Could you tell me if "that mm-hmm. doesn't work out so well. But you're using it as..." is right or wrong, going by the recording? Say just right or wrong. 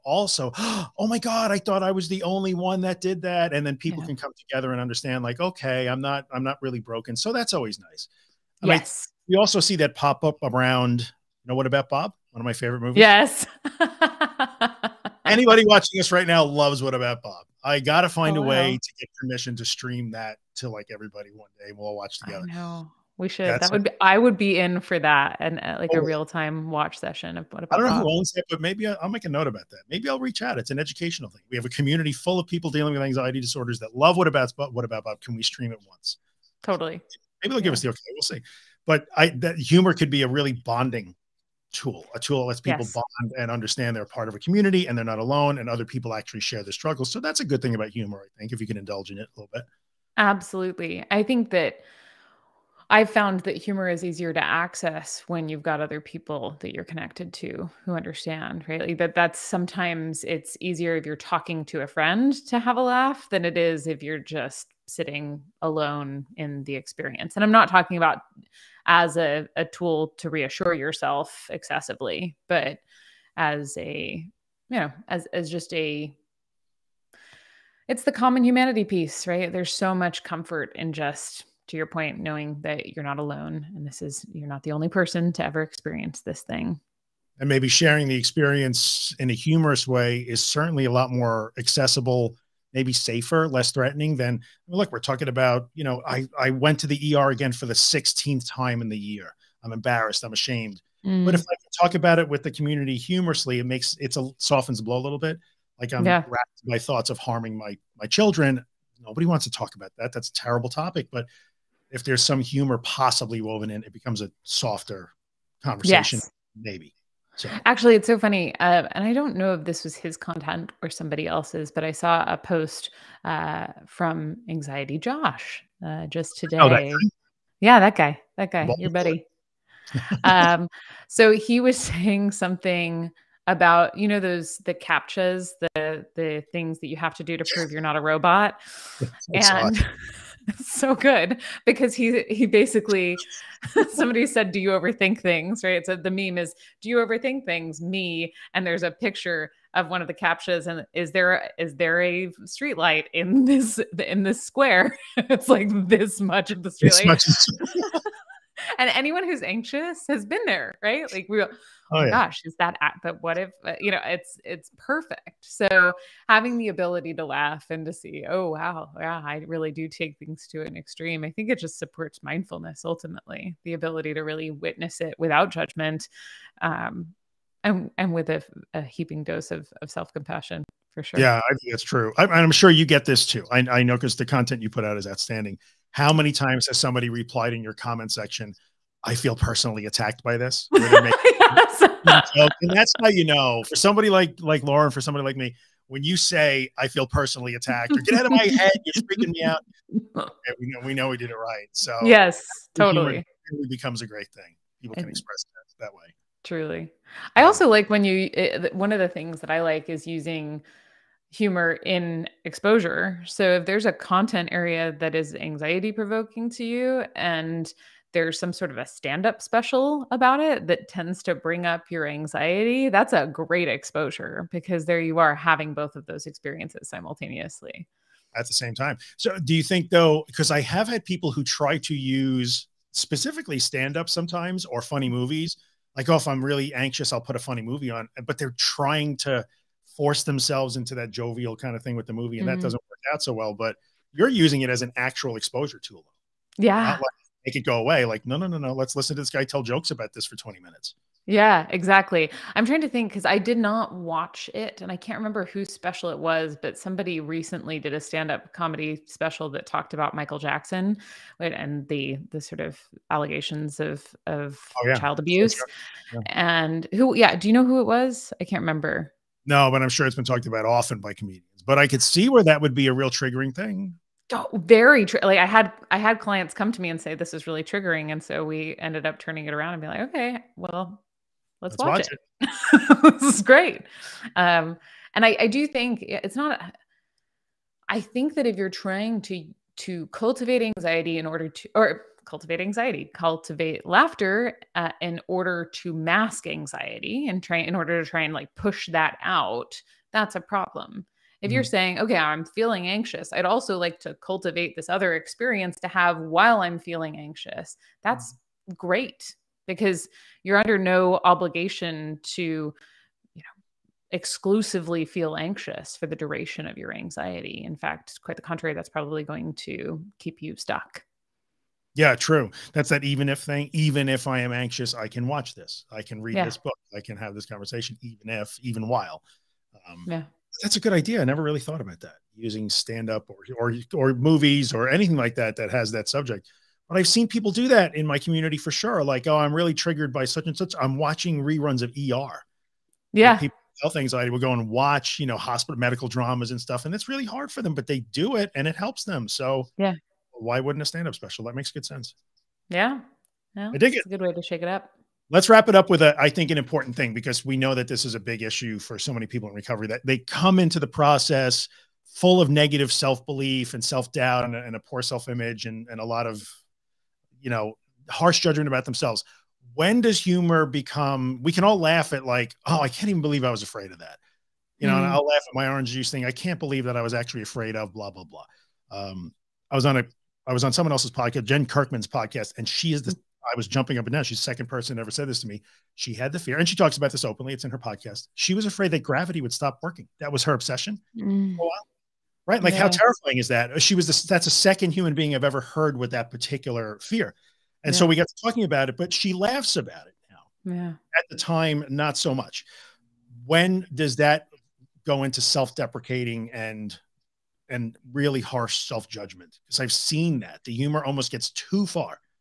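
right.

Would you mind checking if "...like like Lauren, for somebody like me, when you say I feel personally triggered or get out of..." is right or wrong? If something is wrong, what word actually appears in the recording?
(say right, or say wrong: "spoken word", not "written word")
wrong: "attacked", not "triggered".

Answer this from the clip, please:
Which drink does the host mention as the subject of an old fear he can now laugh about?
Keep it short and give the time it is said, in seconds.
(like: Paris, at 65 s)
orange juice, at 375 s.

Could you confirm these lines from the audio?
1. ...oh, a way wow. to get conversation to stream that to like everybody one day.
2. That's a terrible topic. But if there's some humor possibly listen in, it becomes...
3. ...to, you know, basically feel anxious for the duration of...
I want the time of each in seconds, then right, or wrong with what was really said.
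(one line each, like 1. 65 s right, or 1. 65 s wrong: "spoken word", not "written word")
1. 18 s wrong: "permission", not "conversation"
2. 110 s wrong: "woven", not "listen"
3. 312 s wrong: "exclusively", not "basically".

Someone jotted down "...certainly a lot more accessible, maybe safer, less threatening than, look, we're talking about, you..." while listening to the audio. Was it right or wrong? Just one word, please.
right.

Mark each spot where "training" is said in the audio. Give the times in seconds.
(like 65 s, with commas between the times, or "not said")
not said.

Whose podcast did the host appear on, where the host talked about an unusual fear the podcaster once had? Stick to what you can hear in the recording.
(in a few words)
Jen Kirkman.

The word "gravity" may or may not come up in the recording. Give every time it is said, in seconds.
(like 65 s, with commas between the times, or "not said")
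389 s.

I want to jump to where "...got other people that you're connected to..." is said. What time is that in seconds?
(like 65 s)
55 s.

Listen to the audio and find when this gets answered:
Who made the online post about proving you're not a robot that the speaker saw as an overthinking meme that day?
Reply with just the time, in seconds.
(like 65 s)
124 s.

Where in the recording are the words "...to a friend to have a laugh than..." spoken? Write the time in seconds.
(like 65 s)
61 s.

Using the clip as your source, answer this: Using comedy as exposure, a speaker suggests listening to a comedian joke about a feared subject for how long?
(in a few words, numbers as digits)
20 minutes.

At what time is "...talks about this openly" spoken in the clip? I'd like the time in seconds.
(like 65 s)
386 s.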